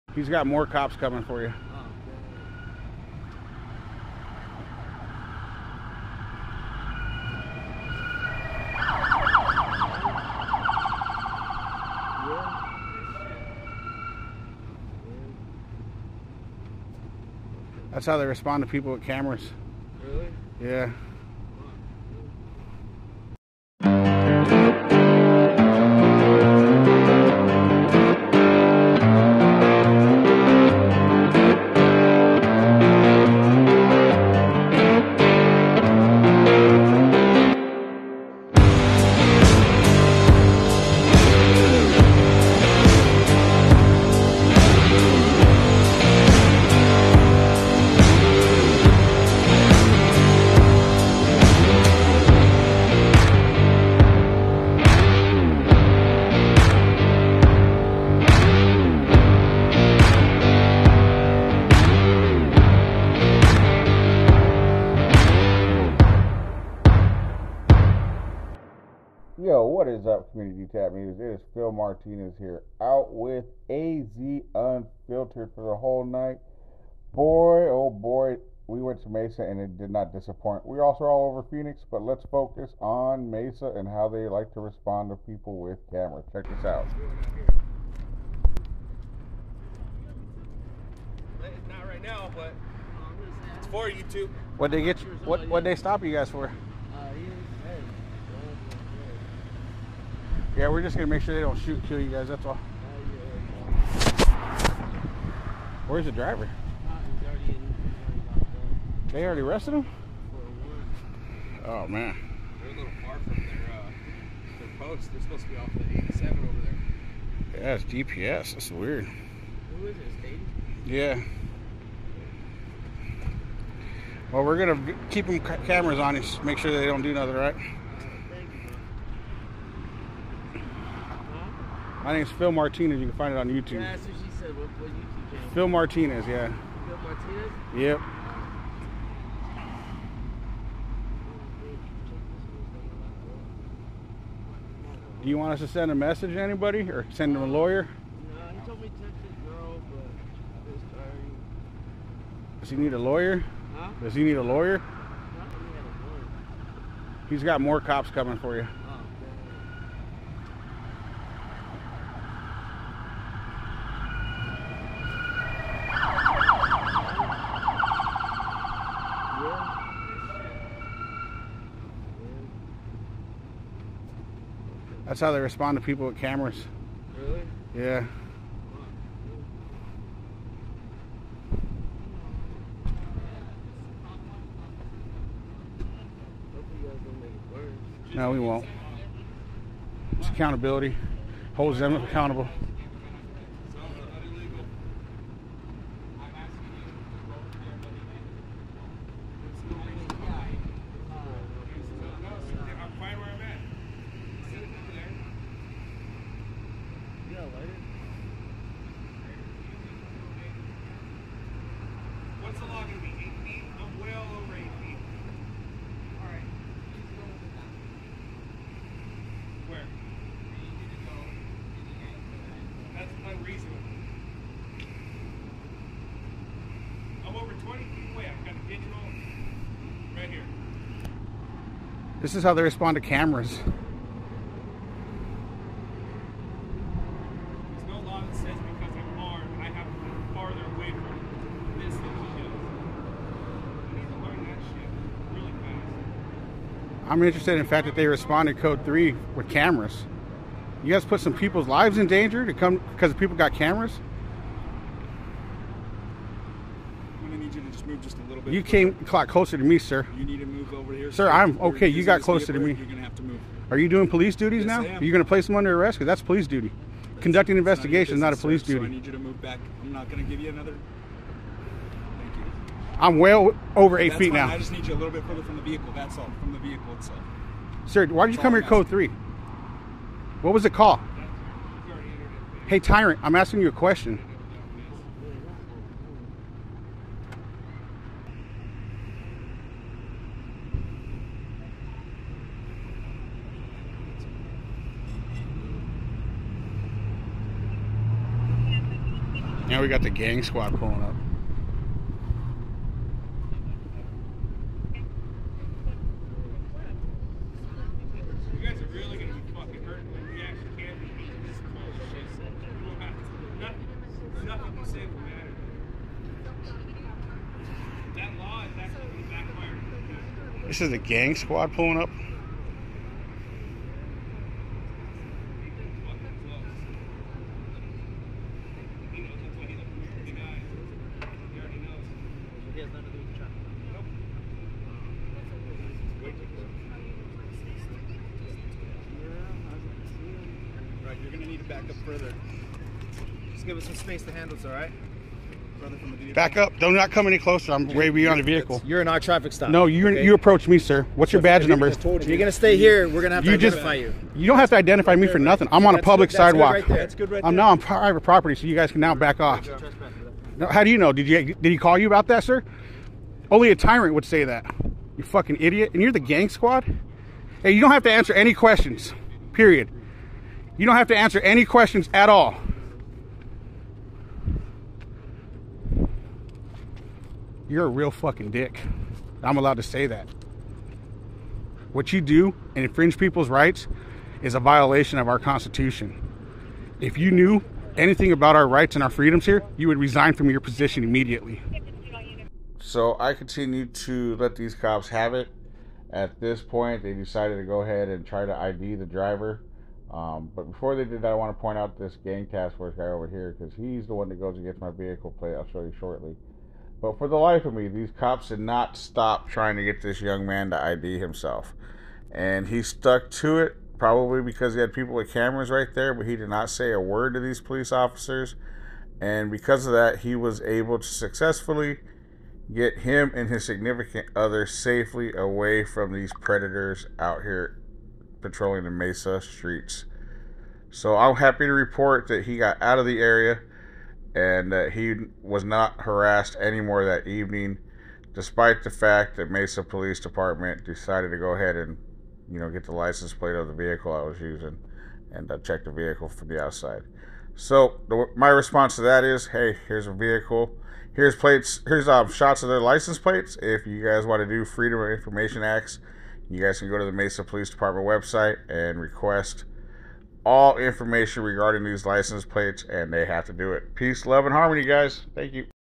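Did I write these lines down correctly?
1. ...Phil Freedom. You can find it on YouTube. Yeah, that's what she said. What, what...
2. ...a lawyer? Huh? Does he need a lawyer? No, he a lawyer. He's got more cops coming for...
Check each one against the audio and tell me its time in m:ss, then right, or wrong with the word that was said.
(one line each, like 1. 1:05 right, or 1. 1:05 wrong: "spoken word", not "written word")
1. 2:12 wrong: "Martinez", not "Freedom"
2. 2:32 right.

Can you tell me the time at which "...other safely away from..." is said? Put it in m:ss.
7:04.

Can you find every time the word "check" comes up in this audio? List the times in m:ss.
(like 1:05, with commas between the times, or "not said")
1:26, 7:25.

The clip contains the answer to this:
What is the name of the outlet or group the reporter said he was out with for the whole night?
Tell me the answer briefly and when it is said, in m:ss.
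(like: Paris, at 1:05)
AZ Unfiltered, at 1:13.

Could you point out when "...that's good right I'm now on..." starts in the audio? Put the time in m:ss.
5:56.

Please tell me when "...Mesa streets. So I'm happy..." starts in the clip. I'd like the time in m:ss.
7:08.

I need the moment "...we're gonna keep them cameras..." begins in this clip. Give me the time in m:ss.
2:04.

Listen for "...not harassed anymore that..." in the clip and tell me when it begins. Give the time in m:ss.
7:15.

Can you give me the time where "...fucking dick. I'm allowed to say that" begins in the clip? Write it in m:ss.
6:18.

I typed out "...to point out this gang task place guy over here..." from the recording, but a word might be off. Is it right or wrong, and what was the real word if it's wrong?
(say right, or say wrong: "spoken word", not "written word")
wrong: "force", not "place".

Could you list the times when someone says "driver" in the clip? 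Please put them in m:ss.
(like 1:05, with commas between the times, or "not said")
1:46, 6:39.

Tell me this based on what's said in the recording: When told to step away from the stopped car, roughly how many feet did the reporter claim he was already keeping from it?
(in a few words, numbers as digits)
8.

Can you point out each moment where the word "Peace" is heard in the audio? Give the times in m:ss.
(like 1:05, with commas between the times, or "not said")
7:43.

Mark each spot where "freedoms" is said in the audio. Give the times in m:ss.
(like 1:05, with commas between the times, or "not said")
6:29, 7:34.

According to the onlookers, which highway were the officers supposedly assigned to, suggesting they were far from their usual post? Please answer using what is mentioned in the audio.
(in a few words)
the 87.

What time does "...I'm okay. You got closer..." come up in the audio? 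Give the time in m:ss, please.
4:21.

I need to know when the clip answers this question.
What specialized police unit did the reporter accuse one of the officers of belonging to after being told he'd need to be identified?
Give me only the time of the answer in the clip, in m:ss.
6:06.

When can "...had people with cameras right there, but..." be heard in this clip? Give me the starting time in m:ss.
6:54.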